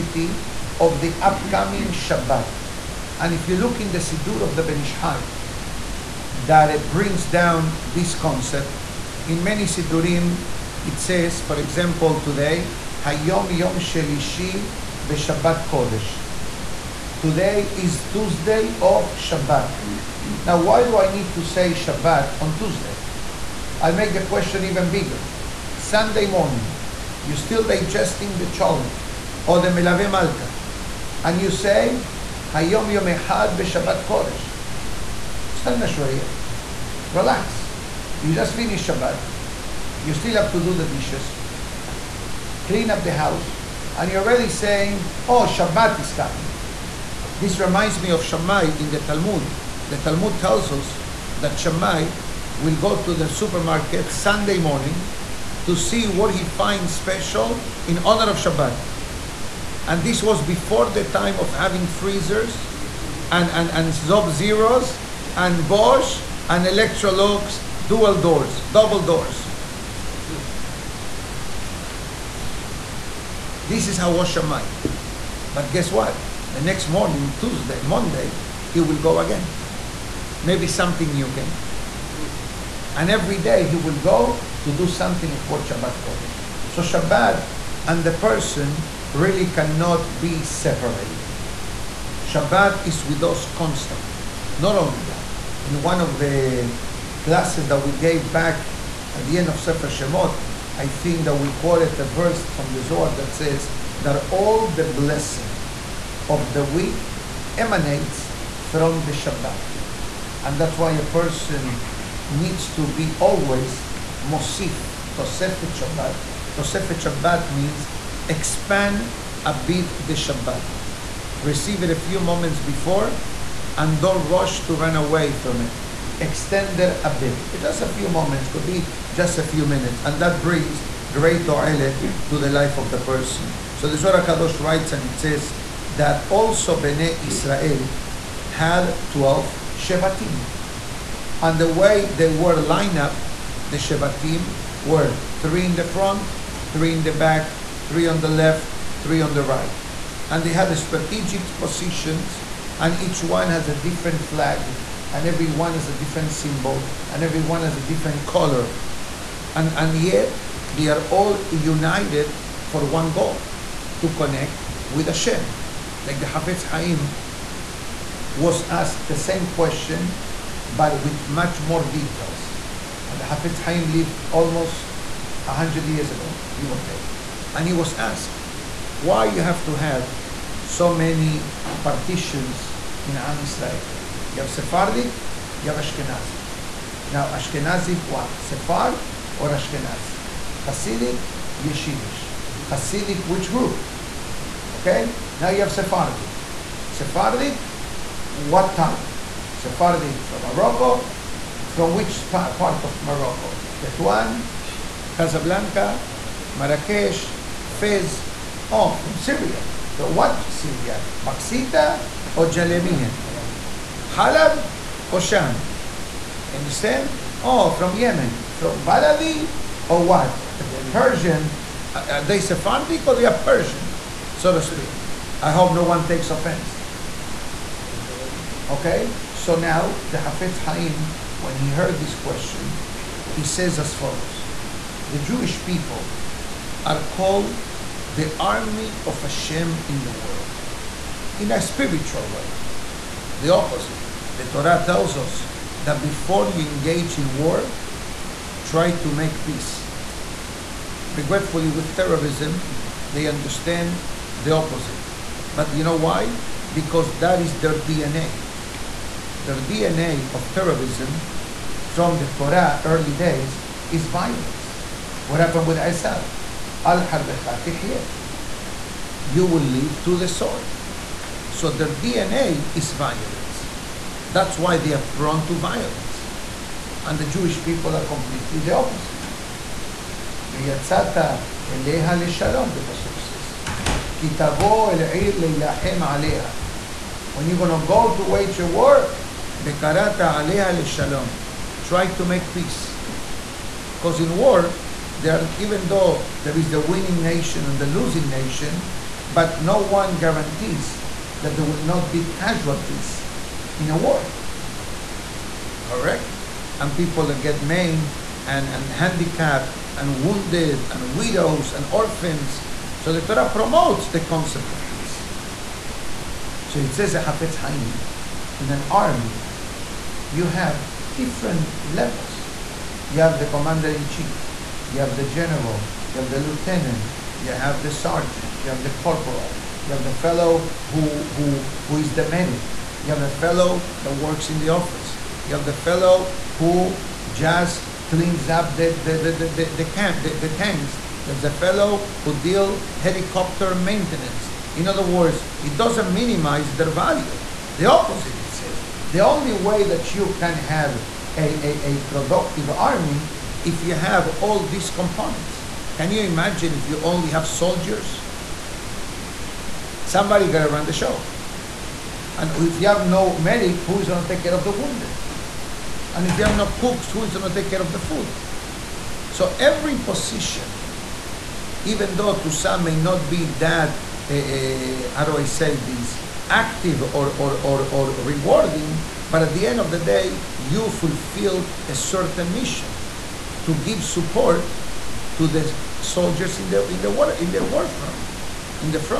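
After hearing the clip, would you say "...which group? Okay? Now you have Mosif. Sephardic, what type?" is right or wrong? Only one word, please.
wrong.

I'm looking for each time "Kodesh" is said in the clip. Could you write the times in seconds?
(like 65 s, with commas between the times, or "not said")
15 s, 34 s, 86 s.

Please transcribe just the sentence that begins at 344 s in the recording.
In other words, it doesn't minimize their value.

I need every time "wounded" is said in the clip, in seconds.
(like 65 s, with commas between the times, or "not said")
310 s, 364 s.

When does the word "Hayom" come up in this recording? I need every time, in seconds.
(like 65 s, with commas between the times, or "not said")
13 s, 32 s.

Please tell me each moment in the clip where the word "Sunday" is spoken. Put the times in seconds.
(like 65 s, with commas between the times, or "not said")
25 s, 54 s.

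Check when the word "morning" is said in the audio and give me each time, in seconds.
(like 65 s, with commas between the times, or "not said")
26 s, 54 s, 76 s.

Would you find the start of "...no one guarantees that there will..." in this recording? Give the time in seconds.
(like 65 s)
299 s.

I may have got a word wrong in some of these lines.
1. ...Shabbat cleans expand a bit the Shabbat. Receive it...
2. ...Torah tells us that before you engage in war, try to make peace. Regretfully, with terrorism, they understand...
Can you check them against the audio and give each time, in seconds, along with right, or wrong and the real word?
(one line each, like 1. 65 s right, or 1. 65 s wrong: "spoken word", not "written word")
1. 117 s wrong: "means", not "cleans"
2. 244 s right.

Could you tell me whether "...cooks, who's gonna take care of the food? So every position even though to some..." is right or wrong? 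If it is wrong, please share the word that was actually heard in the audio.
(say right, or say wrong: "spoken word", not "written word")
right.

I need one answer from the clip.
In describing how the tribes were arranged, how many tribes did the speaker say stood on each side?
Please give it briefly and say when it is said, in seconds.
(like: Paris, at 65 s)
3, at 145 s.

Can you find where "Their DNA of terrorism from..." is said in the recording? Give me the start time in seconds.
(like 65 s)
259 s.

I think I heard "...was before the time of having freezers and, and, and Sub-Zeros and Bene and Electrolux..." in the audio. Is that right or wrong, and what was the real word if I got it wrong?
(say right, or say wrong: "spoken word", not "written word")
wrong: "Bosch", not "Bene".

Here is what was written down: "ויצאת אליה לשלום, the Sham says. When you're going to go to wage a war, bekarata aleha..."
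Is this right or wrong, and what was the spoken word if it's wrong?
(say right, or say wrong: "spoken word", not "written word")
wrong: "Pasuk", not "Sham".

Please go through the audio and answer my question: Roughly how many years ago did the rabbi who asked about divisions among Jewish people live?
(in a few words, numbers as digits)
100.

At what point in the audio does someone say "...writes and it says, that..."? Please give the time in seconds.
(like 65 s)
134 s.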